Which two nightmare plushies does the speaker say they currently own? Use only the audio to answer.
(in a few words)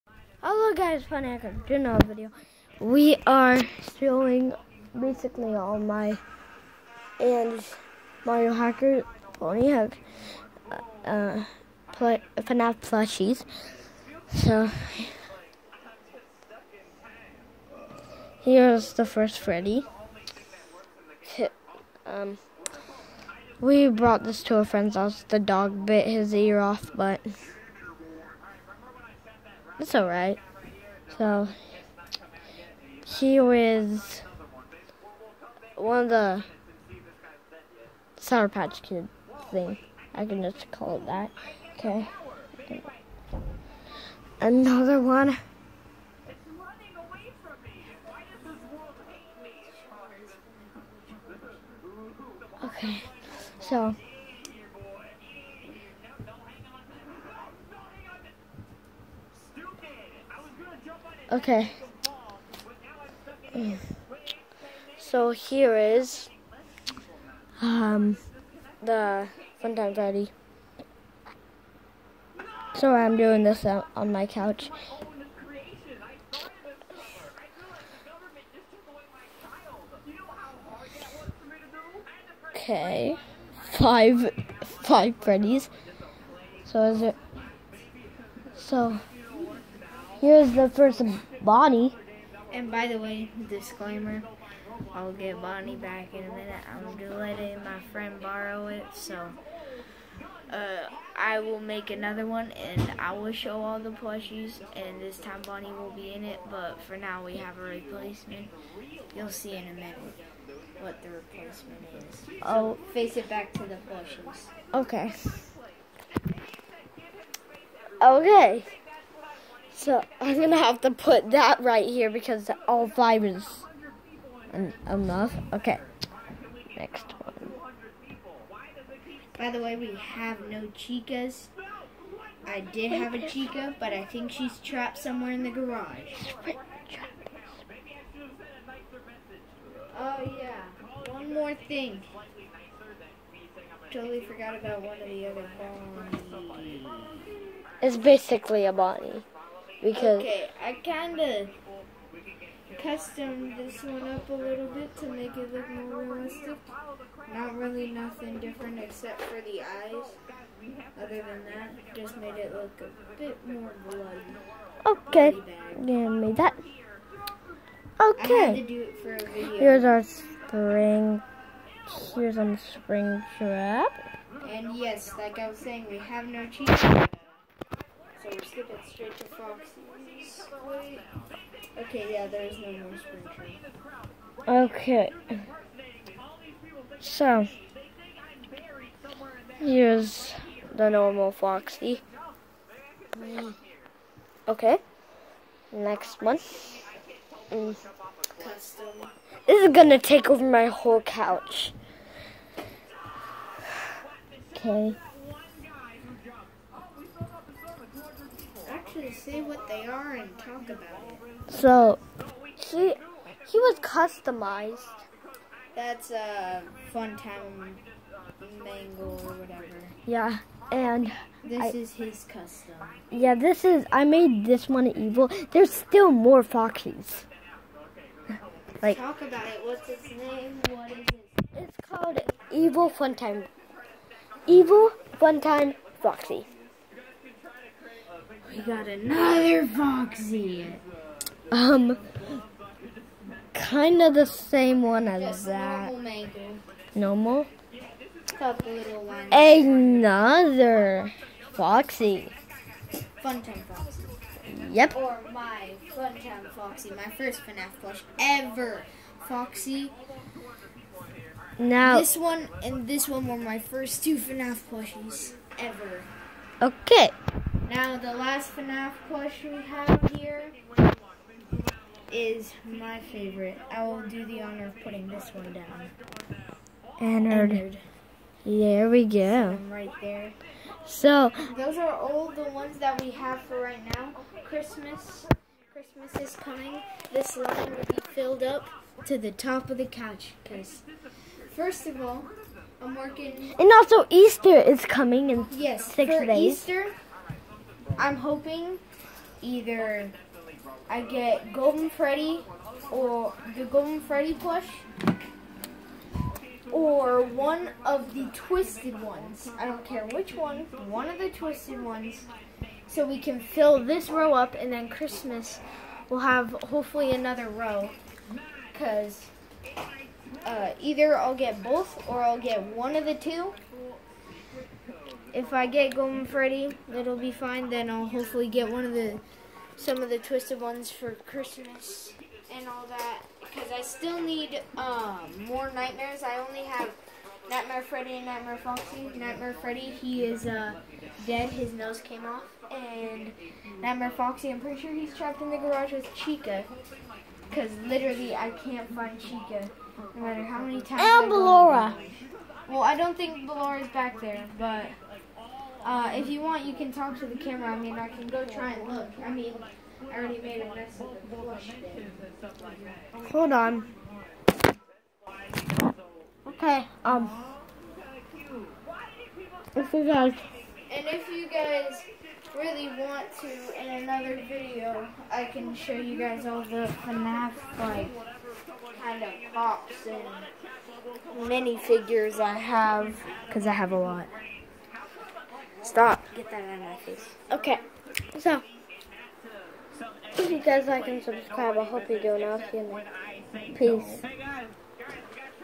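Nightmare Freddy and Nightmare Foxy.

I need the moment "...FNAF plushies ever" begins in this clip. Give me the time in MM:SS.
04:24.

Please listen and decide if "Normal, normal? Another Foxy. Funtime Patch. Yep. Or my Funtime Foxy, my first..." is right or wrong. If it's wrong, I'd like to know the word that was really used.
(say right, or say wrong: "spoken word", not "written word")
wrong: "Foxy", not "Patch".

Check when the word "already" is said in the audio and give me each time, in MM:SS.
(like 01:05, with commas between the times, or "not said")
06:00.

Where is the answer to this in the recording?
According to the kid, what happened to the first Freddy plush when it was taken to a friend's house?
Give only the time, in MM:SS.
00:25.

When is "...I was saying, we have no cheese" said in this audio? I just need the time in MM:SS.
02:55.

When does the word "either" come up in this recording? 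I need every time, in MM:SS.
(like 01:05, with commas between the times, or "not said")
04:59, 05:20.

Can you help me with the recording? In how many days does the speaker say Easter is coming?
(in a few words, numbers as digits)
6.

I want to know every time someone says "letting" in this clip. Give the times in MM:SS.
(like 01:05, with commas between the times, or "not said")
01:37.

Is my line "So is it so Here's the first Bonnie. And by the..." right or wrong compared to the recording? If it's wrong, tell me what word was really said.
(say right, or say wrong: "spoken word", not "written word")
right.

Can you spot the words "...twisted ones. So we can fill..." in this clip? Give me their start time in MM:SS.
05:11.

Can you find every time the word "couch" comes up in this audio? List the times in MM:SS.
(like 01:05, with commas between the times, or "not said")
01:14, 03:21, 04:49.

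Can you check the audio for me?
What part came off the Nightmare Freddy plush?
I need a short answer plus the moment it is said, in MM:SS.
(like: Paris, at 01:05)
His nose, at 05:41.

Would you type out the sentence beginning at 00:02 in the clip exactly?
We are showing basically all my and Mario Hacker Pony Hug uh, uh, play, FNAF plushies.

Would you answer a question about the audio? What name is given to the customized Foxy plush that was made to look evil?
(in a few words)
Evil Funtime Foxy.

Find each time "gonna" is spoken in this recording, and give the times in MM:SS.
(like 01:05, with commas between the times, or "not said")
02:00, 03:19.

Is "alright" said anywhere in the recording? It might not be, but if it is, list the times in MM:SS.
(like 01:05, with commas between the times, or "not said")
00:29.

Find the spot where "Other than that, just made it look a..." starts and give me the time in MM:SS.
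02:41.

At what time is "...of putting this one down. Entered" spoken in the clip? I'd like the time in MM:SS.
04:34.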